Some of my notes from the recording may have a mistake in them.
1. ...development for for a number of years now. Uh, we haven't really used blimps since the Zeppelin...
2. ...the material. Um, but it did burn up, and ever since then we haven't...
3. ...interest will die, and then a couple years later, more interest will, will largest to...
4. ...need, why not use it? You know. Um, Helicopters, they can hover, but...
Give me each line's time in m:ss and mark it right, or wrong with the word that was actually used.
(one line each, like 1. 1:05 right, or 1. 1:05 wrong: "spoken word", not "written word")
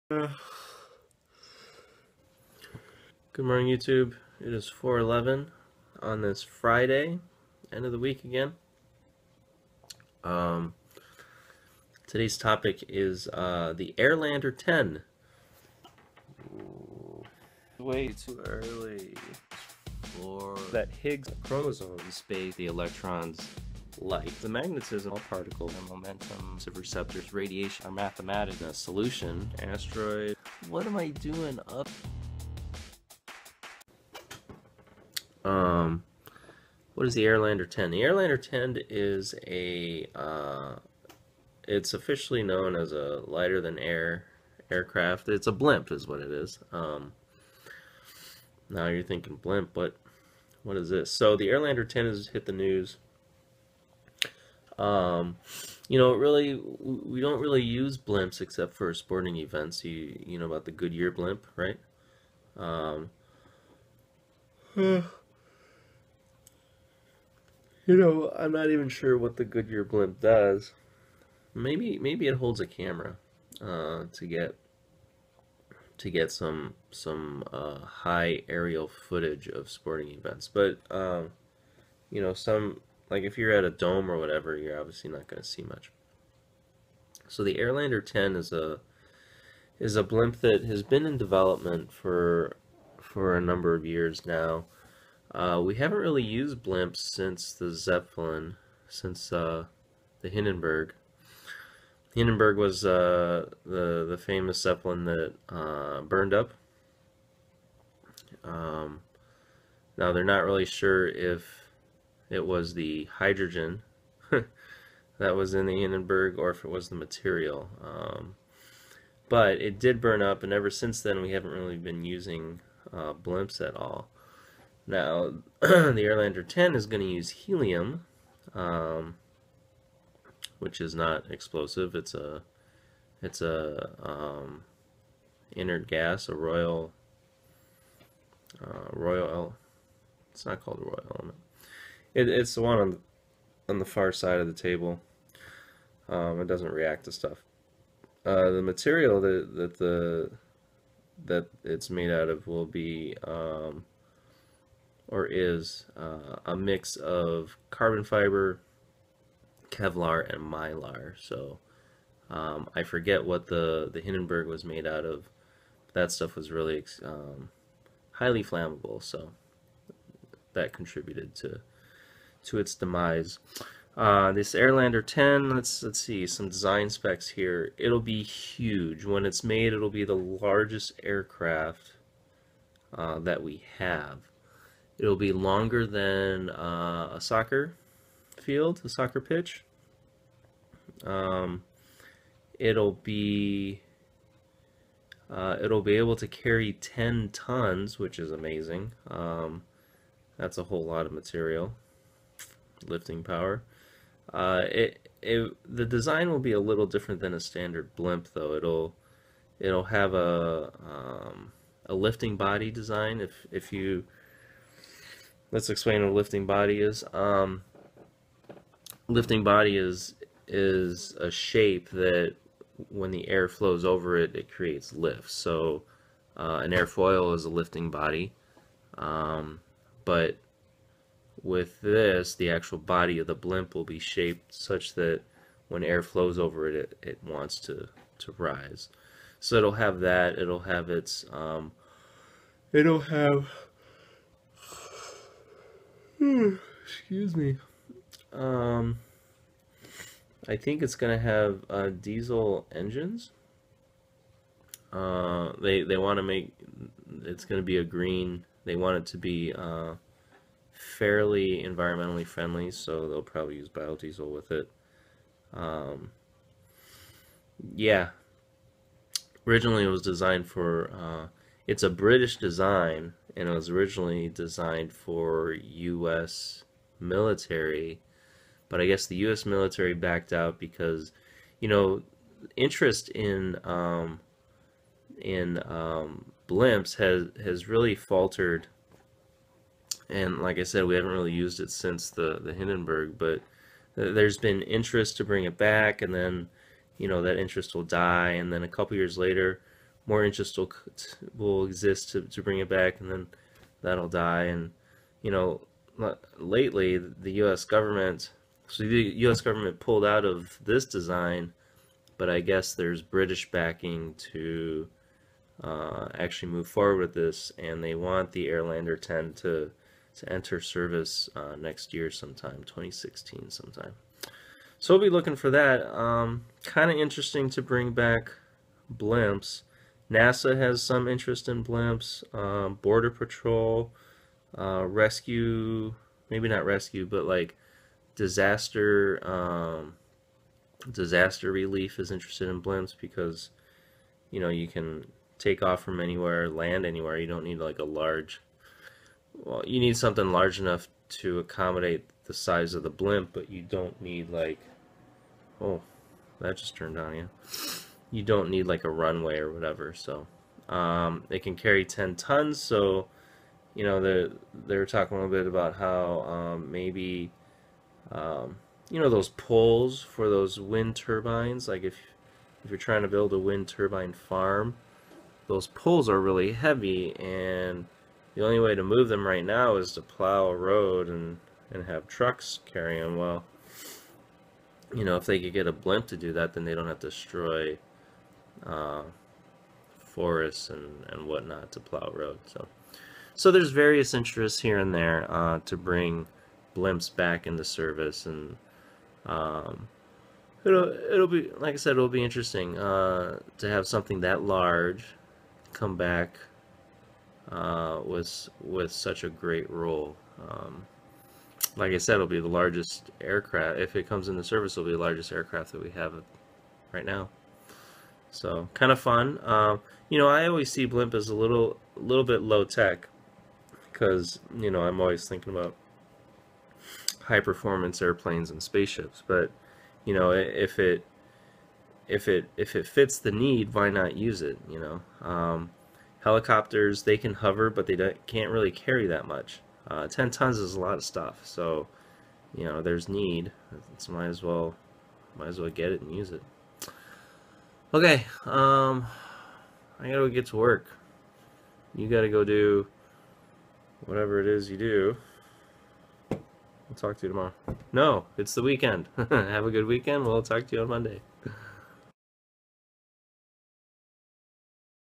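1. 1:31 right
2. 1:56 right
3. 4:57 wrong: "exist", not "largest"
4. 7:13 right.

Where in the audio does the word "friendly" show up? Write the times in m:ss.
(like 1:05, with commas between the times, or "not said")
4:22.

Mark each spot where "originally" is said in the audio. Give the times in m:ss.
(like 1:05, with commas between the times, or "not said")
4:29, 4:33.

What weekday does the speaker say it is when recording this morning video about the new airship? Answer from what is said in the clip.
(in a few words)
Friday.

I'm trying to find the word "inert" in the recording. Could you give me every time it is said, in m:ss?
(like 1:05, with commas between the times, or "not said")
2:15.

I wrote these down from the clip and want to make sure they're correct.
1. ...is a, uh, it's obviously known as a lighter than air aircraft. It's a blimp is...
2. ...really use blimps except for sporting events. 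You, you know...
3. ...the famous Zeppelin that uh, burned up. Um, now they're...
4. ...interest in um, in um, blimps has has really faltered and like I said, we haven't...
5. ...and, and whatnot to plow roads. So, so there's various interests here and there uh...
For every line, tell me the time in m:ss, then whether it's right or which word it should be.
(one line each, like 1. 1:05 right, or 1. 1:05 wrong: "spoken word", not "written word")
1. 0:38 wrong: "officially", not "obviously"
2. 0:57 right
3. 1:44 right
4. 4:42 right
5. 6:30 right.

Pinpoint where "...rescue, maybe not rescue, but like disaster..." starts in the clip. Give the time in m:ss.
5:34.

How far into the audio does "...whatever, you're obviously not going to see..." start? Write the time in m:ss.
1:24.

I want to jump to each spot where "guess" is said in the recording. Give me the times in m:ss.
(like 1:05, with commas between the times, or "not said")
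4:38, 5:12.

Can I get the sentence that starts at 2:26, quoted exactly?
Um, it doesn't react to stuff.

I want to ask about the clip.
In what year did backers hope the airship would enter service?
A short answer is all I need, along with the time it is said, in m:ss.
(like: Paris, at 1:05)
2016, at 5:22.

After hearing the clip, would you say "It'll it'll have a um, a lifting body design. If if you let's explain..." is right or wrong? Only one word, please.
right.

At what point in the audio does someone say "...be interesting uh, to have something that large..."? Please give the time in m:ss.
6:42.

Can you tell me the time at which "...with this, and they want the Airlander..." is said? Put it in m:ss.
5:16.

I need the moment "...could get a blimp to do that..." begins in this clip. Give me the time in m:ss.
6:25.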